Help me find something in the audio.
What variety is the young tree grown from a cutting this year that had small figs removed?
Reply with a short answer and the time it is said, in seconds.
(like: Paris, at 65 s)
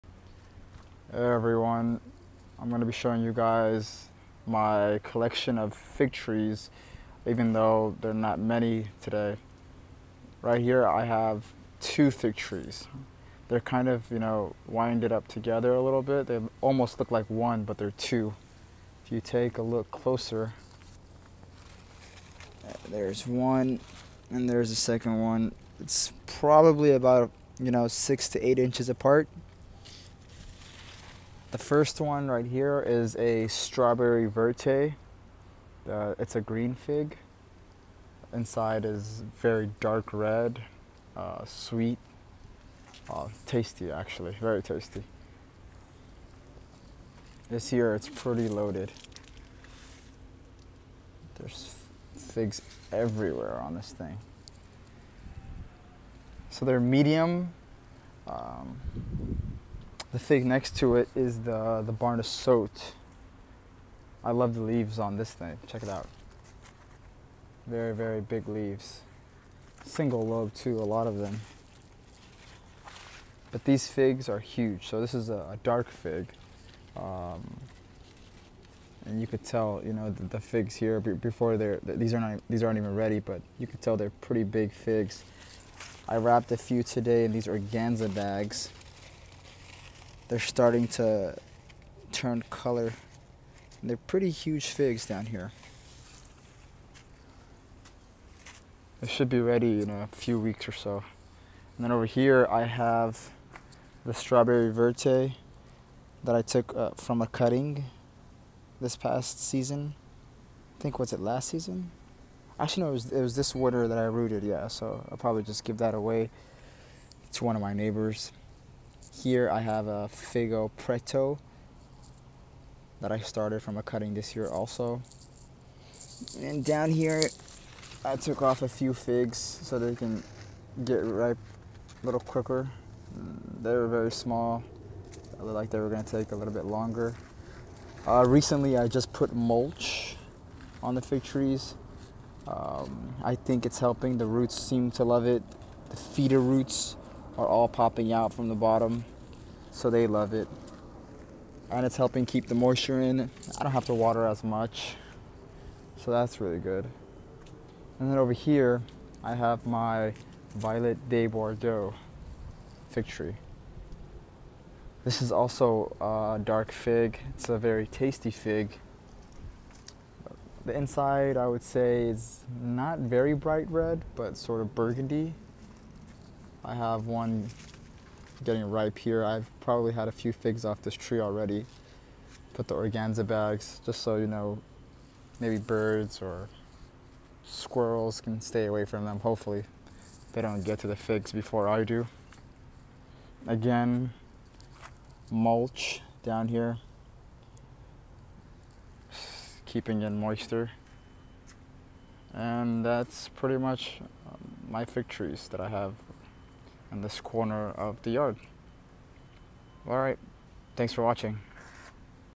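Figo Preto, at 120 s.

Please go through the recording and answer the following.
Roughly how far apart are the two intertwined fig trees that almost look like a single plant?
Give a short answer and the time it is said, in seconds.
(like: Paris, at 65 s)
6 to 8 inches, at 27 s.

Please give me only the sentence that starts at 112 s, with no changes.
Actually, no, it was, it was this winter that I rooted, yeah.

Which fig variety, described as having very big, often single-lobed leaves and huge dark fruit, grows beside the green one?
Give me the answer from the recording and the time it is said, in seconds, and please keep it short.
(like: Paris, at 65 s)
Barna, at 61 s.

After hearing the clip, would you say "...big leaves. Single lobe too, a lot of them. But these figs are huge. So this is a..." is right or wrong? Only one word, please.
right.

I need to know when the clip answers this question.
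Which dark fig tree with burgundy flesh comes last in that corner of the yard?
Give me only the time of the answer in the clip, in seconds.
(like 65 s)
160 s.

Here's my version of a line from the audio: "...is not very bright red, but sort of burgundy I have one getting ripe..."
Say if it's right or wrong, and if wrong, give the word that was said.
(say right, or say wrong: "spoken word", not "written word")
right.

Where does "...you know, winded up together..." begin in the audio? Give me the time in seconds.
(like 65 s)
14 s.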